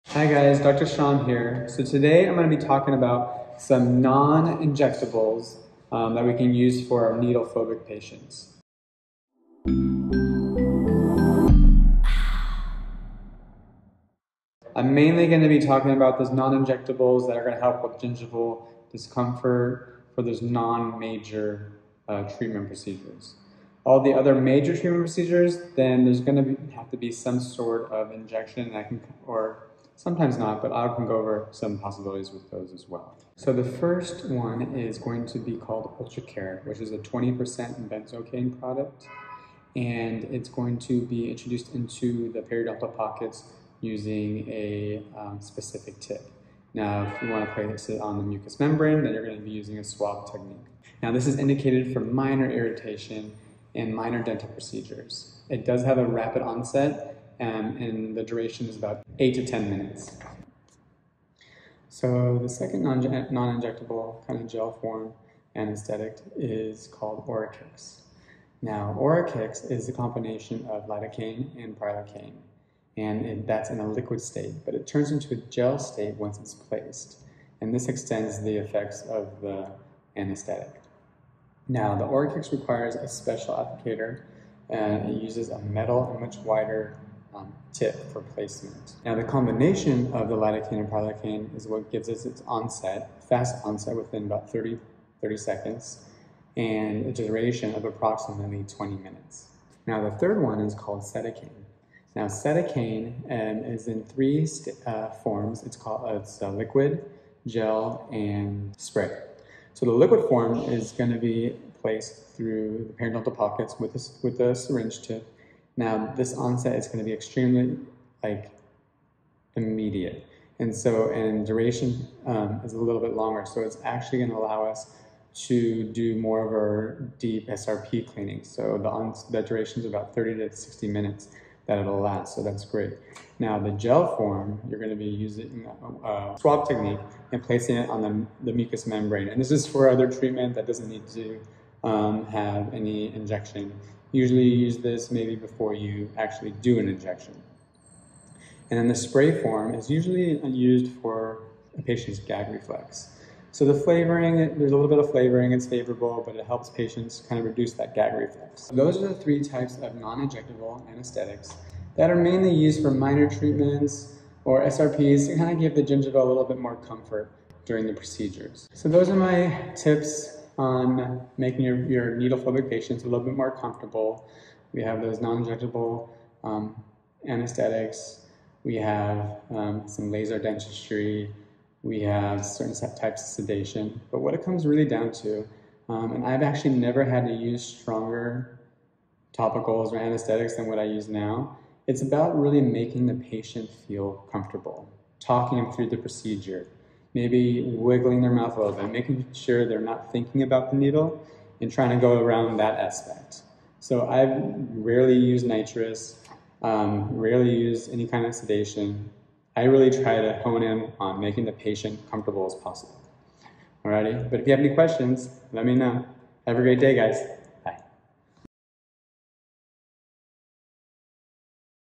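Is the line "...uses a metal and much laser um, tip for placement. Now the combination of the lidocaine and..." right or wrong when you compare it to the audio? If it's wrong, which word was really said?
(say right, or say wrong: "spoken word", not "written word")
wrong: "wider", not "laser".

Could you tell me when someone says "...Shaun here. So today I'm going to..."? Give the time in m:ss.
0:00.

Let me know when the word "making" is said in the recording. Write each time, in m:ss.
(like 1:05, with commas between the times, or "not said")
2:51, 3:12, 3:18, 3:31.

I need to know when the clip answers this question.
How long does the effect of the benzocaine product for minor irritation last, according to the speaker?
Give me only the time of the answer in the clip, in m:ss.
0:59.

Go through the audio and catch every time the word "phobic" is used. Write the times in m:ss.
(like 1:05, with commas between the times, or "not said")
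0:07, 2:52.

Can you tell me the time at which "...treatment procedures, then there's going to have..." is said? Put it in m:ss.
0:24.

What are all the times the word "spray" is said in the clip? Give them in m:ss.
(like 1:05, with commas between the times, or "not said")
1:48, 2:28.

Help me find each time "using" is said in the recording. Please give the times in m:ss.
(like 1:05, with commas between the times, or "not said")
0:43, 0:49, 2:15.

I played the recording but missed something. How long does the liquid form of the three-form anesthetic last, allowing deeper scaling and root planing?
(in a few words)
30 to 60 minutes.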